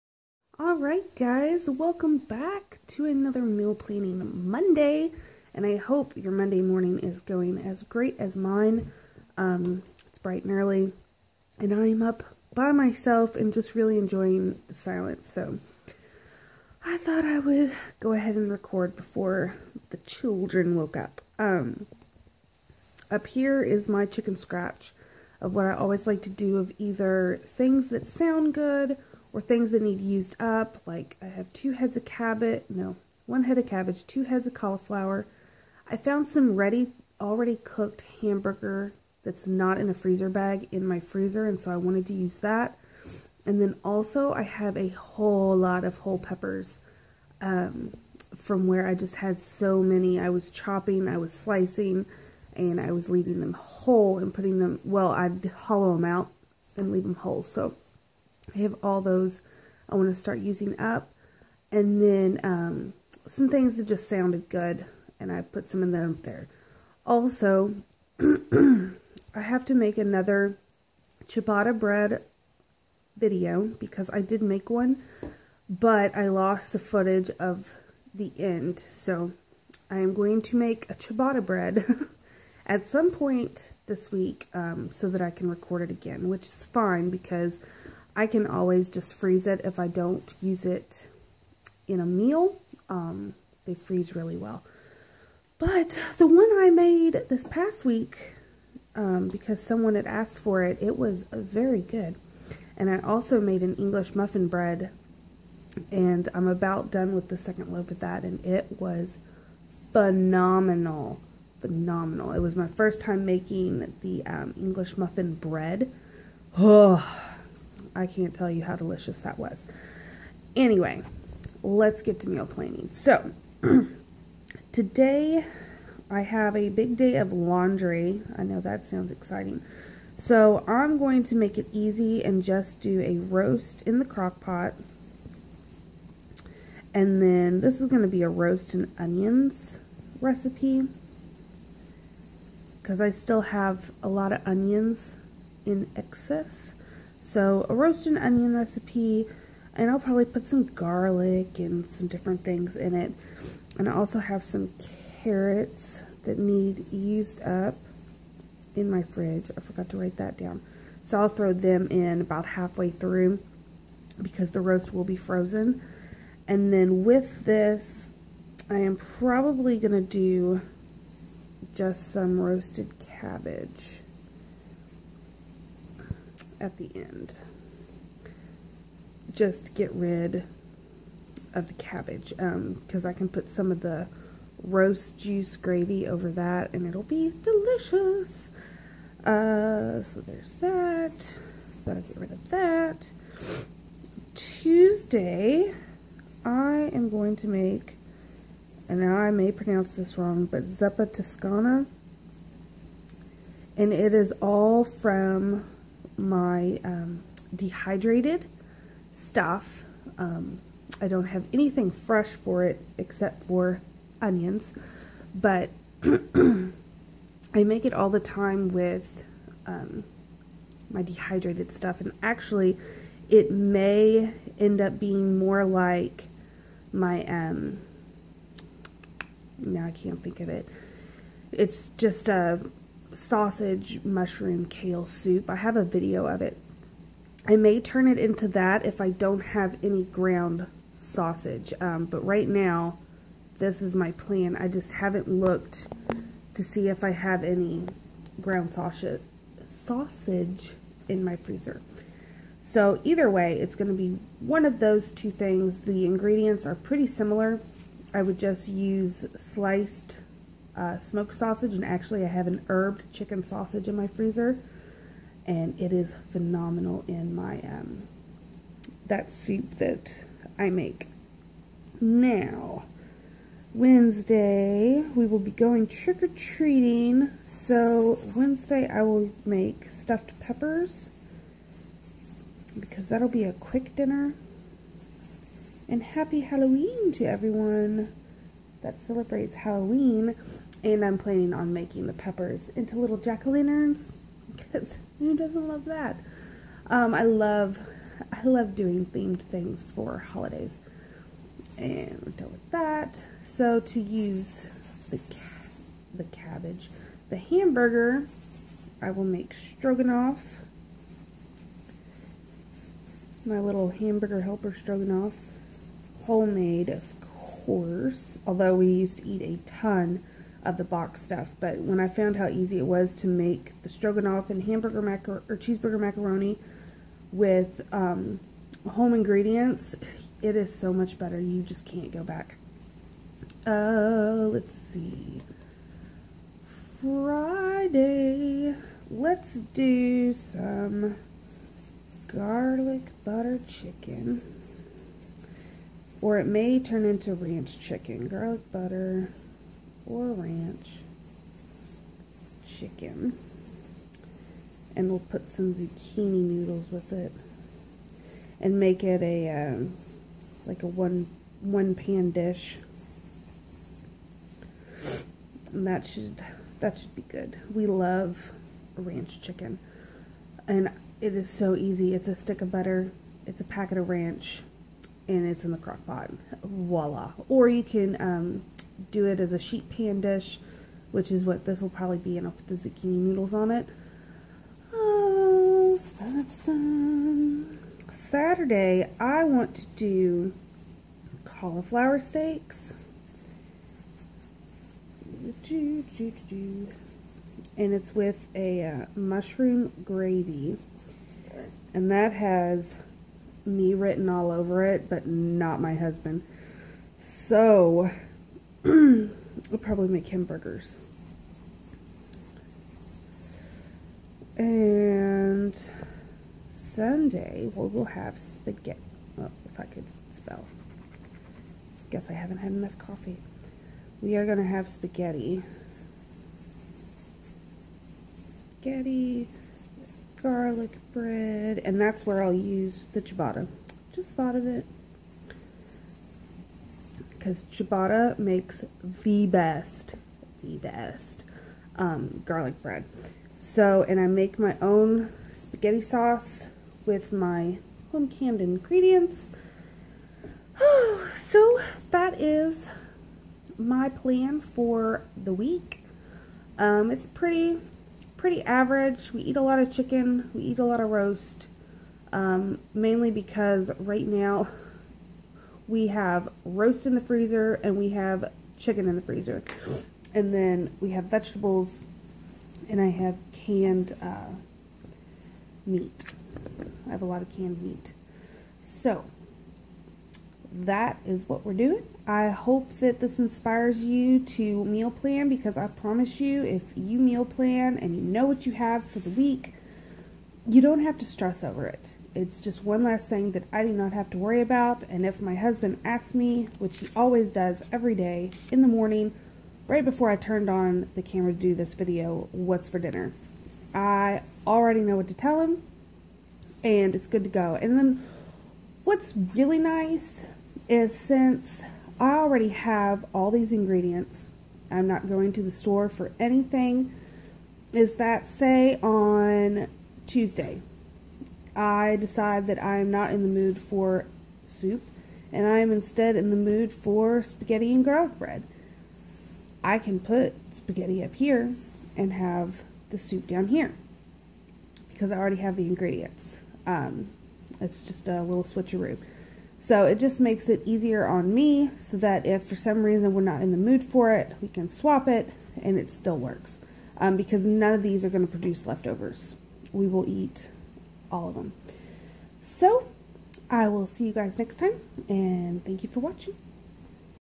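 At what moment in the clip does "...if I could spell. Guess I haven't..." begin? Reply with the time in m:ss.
6:59.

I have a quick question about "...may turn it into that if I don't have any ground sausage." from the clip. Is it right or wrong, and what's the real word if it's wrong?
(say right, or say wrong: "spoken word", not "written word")
right.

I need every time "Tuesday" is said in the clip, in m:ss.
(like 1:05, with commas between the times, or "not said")
3:14, 8:40.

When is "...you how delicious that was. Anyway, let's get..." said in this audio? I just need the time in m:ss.
1:58.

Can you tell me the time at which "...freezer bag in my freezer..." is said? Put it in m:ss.
0:39.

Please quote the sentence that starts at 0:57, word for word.
So I have all those I want to start using up.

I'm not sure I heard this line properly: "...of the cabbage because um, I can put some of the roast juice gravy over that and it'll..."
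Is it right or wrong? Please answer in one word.
right.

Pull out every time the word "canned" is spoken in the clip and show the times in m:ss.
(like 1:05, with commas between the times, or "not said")
7:28, 7:53, 7:57.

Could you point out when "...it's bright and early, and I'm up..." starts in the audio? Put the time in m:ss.
0:10.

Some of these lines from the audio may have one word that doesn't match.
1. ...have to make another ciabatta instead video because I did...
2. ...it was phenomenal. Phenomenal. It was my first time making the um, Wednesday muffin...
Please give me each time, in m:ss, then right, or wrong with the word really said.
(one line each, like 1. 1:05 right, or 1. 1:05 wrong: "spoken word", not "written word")
1. 1:09 wrong: "bread", not "instead"
2. 1:48 wrong: "English", not "Wednesday".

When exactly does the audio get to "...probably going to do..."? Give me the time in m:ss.
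2:48.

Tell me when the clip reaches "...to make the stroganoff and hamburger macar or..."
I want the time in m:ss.
5:23.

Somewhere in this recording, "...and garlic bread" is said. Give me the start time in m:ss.
8:47.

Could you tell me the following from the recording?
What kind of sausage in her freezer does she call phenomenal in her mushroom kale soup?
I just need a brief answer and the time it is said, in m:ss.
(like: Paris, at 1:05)
Herbed chicken sausage, at 4:22.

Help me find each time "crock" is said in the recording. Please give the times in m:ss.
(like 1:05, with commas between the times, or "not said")
2:14, 6:15.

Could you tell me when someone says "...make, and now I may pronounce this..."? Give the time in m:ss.
3:17.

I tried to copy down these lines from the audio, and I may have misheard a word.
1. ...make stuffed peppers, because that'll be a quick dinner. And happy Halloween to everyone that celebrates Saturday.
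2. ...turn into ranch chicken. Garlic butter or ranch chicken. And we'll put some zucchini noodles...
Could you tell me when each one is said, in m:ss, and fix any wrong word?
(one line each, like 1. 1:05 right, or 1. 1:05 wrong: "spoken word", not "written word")
1. 4:39 wrong: "Halloween", not "Saturday"
2. 5:46 right.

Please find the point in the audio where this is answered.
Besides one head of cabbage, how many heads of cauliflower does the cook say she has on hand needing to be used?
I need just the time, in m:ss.
0:34.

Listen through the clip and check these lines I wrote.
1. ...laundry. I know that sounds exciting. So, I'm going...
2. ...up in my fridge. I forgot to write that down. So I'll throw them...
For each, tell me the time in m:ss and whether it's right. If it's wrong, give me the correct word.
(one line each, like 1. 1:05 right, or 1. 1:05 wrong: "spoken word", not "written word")
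1. 2:07 right
2. 2:37 right.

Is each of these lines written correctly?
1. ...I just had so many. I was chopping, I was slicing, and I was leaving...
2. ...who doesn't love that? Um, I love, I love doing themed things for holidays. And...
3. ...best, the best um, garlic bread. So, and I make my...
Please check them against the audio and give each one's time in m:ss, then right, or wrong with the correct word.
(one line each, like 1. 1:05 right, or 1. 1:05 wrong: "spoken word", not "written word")
1. 0:48 right
2. 4:55 right
3. 7:19 right.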